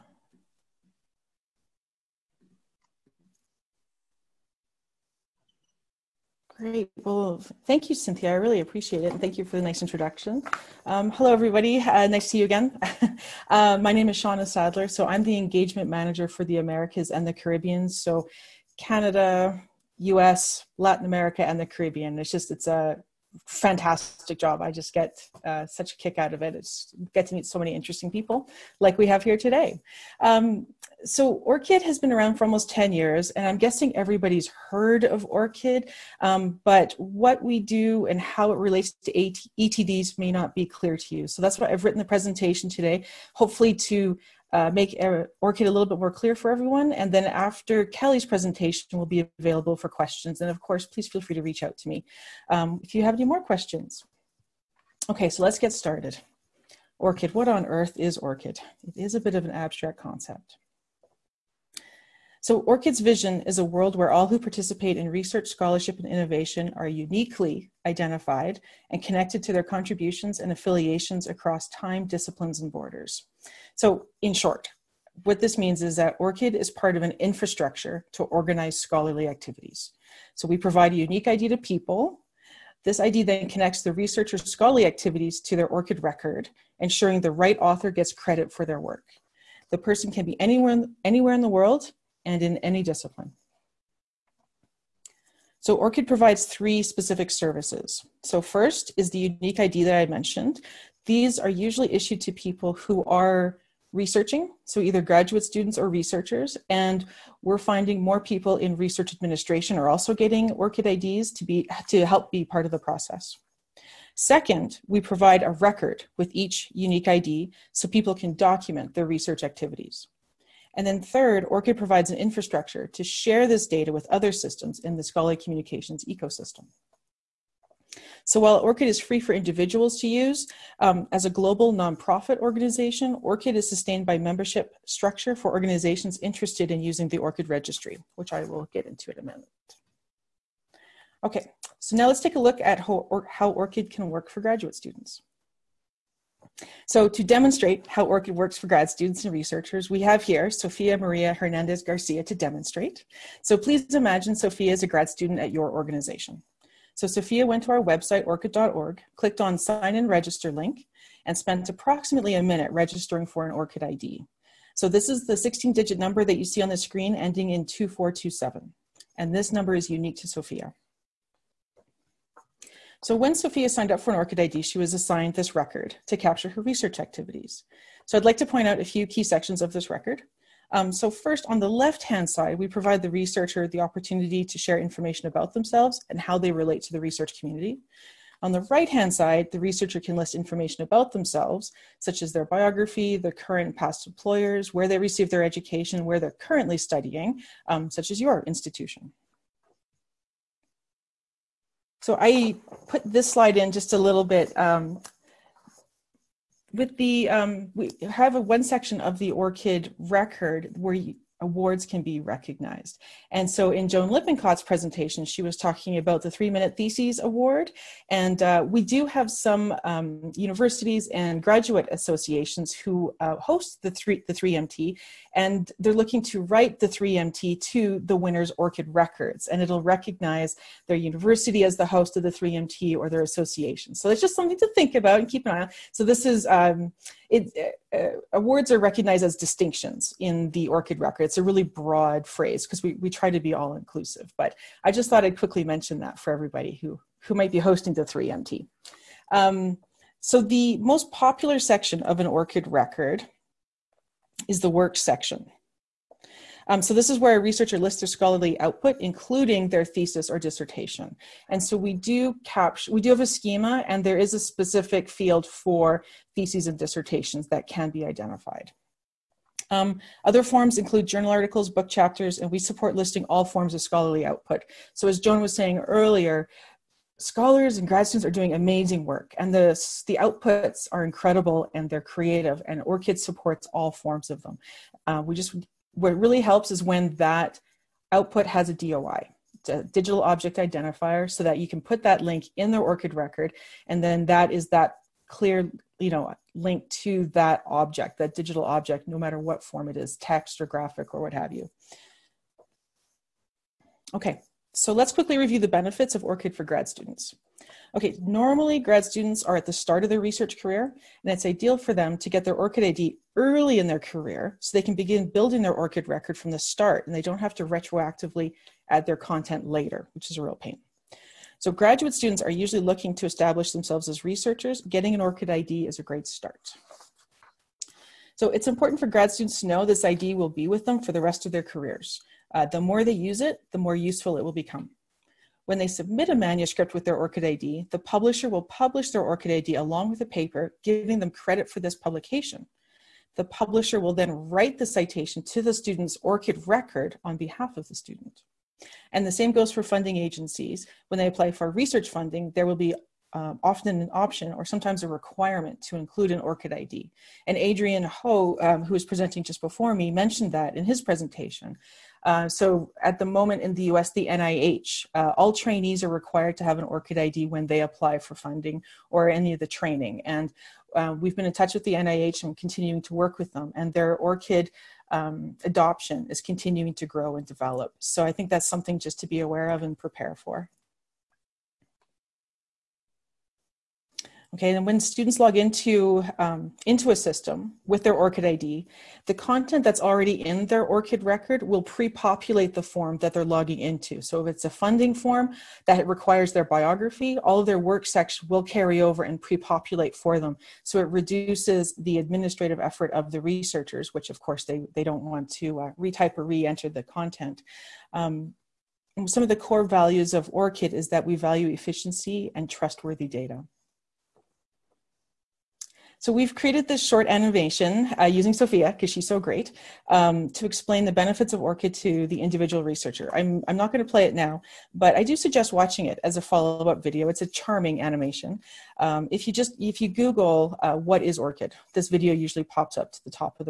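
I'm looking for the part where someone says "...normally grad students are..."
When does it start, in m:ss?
5:08.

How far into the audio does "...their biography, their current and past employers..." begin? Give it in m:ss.
3:12.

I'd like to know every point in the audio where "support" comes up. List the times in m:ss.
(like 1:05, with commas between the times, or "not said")
4:32, 4:43.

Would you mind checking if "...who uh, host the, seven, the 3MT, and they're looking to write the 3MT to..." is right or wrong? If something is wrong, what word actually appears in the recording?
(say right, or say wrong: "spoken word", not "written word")
wrong: "three", not "seven".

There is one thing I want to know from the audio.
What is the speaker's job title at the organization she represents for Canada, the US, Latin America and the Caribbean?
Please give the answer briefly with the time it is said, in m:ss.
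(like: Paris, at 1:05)
Engagement manager, at 0:15.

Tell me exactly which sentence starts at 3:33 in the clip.
And so in Joan Lippincott's presentation, she was talking about the Three Minute Theses Award.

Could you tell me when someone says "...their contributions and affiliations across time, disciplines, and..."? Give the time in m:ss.
1:09.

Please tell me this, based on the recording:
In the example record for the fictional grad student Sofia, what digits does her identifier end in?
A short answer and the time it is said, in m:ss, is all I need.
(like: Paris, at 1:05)
2427, at 2:47.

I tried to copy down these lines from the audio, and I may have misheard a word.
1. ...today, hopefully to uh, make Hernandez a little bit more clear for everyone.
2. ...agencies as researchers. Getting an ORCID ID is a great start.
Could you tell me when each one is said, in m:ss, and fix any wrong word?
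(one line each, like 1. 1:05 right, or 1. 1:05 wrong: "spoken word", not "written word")
1. 0:42 wrong: "ORCID", not "Hernandez"
2. 5:23 wrong: "themselves", not "agencies".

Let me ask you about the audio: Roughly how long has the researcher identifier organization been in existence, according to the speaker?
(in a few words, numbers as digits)
Almost 10 years.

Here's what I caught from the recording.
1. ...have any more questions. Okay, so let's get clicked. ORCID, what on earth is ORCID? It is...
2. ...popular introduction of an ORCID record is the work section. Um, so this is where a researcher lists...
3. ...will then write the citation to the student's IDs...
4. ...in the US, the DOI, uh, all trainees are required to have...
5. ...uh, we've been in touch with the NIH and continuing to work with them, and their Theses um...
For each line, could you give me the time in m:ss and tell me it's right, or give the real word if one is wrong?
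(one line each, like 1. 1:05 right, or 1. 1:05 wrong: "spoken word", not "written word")
1. 0:53 wrong: "started", not "clicked"
2. 4:11 wrong: "section", not "introduction"
3. 5:43 wrong: "ORCID", not "IDs"
4. 6:03 wrong: "NIH", not "DOI"
5. 6:10 wrong: "ORCID", not "Theses".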